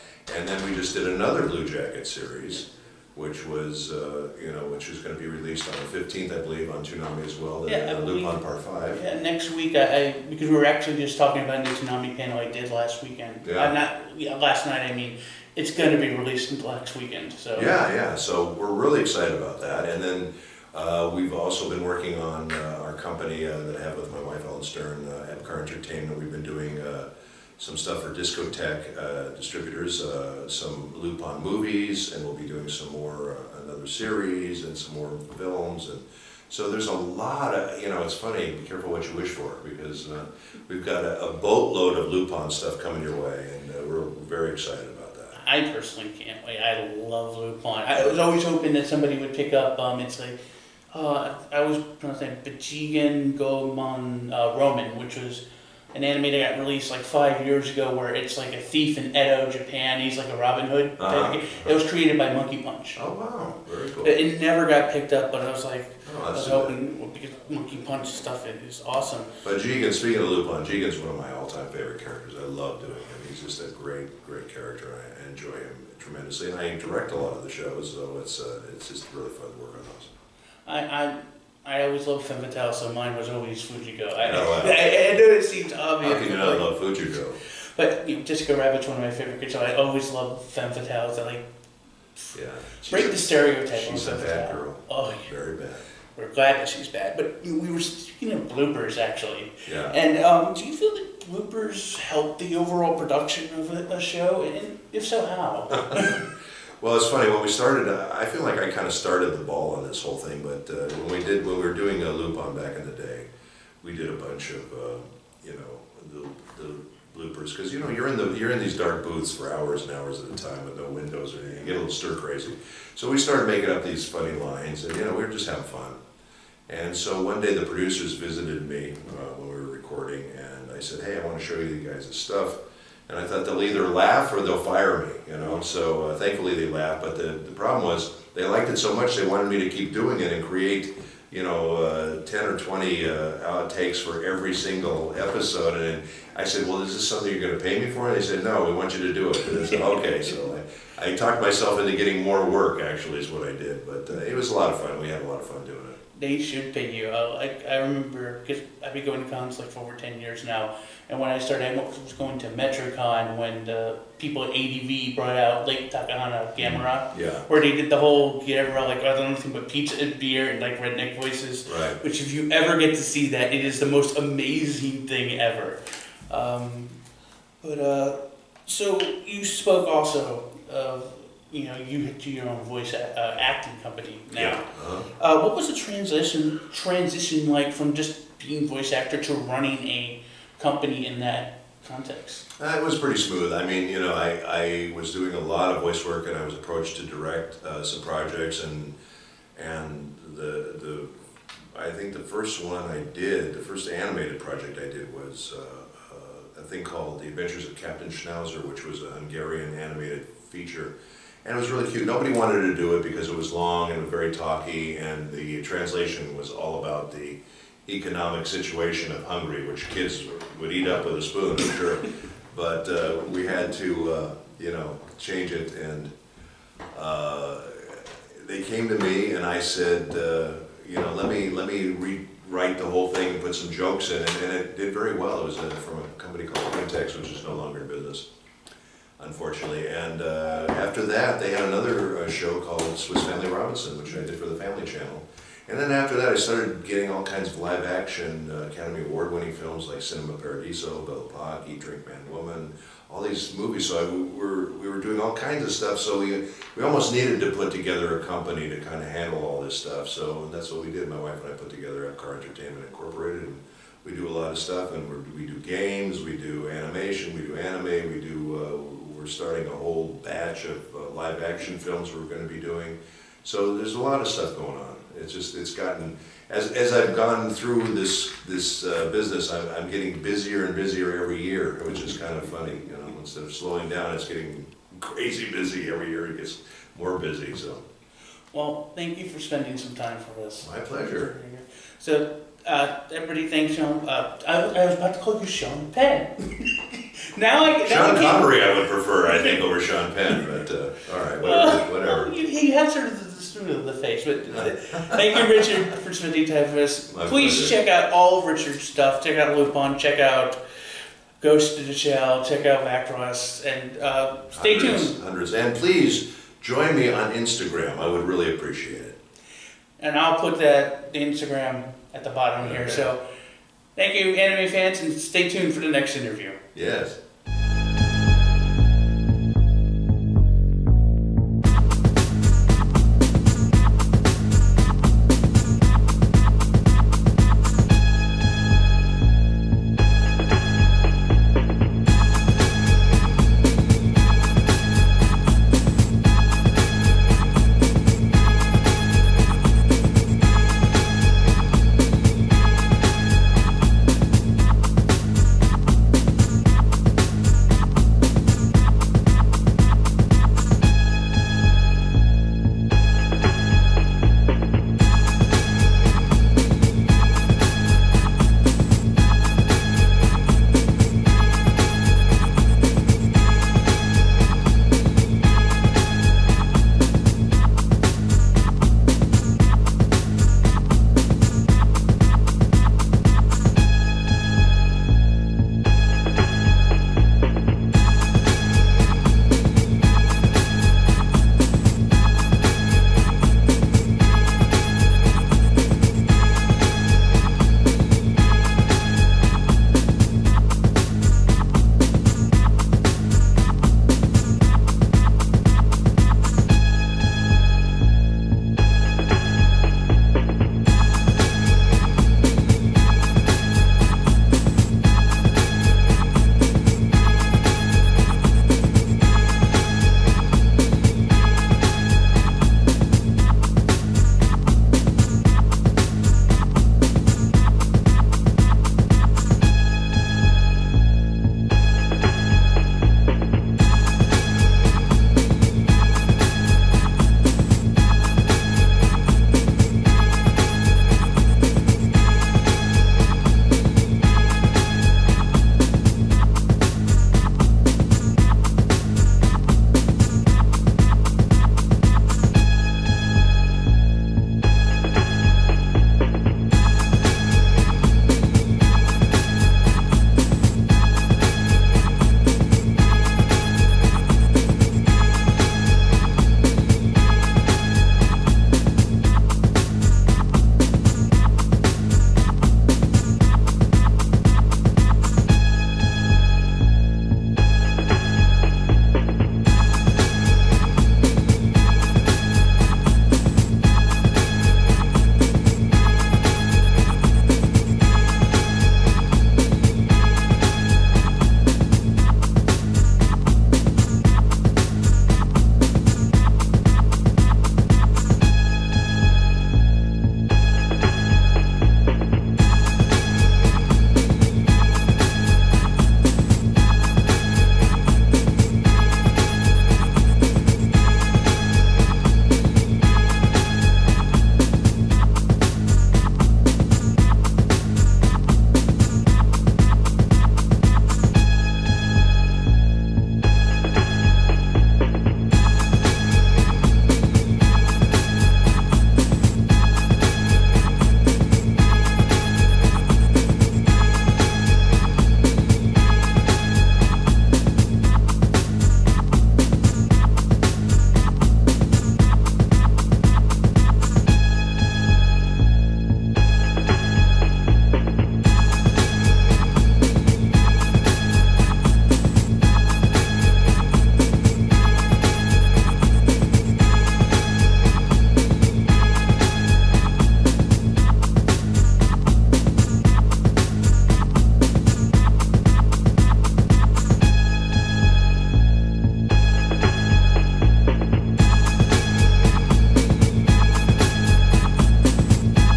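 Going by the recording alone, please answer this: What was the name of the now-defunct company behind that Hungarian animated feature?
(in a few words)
Quintex.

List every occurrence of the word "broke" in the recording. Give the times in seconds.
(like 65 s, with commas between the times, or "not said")
not said.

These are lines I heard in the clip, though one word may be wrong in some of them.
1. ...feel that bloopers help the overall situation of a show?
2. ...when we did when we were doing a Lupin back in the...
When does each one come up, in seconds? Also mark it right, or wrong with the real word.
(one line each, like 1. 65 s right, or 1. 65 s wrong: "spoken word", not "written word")
1. 100 s wrong: "production", not "situation"
2. 111 s right.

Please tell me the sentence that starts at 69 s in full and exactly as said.
But Jigen, speaking of Lupin, Jigen's one of my all-time favorite characters.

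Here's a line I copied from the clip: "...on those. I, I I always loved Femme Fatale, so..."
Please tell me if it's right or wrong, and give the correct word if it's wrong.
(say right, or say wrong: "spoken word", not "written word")
right.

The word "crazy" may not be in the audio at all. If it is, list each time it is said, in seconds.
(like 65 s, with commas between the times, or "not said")
122 s, 285 s.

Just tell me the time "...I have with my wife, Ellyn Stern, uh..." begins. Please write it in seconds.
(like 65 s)
23 s.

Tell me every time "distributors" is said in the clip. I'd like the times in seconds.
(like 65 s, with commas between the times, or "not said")
29 s.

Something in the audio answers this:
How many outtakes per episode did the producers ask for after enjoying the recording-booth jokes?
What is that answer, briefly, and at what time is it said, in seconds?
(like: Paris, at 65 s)
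10 or 20, at 142 s.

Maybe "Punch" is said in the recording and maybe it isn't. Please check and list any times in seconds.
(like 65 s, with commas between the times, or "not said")
62 s, 67 s.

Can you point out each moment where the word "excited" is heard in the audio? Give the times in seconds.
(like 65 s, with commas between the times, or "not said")
19 s, 44 s.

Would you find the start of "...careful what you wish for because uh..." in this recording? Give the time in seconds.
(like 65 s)
38 s.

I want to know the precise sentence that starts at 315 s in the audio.
Hundreds, and please join me on Instagram, I would really appreciate it.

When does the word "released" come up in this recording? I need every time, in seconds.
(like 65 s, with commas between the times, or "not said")
5 s, 16 s, 56 s.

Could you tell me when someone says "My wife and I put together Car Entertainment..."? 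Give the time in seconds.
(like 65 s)
261 s.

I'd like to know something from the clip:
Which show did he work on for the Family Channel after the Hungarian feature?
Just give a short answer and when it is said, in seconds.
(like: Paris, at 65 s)
Swiss Family Robinson, at 242 s.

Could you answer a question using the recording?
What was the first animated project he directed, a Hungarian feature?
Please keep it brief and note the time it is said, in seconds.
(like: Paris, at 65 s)
The Adventures of Captain Schnauzer, at 207 s.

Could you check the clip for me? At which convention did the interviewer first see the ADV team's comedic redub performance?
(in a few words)
MetroCon.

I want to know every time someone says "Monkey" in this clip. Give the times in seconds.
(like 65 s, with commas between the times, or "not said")
62 s, 67 s.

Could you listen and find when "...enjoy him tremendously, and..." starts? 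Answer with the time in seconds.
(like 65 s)
75 s.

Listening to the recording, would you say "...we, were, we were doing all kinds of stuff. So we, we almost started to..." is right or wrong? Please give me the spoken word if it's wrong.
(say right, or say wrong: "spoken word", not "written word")
wrong: "needed", not "started".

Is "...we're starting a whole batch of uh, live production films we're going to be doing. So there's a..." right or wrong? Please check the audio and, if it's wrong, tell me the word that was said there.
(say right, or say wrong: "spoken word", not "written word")
wrong: "action", not "production".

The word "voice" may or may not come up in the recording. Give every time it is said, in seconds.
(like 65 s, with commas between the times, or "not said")
171 s, 182 s, 188 s, 195 s.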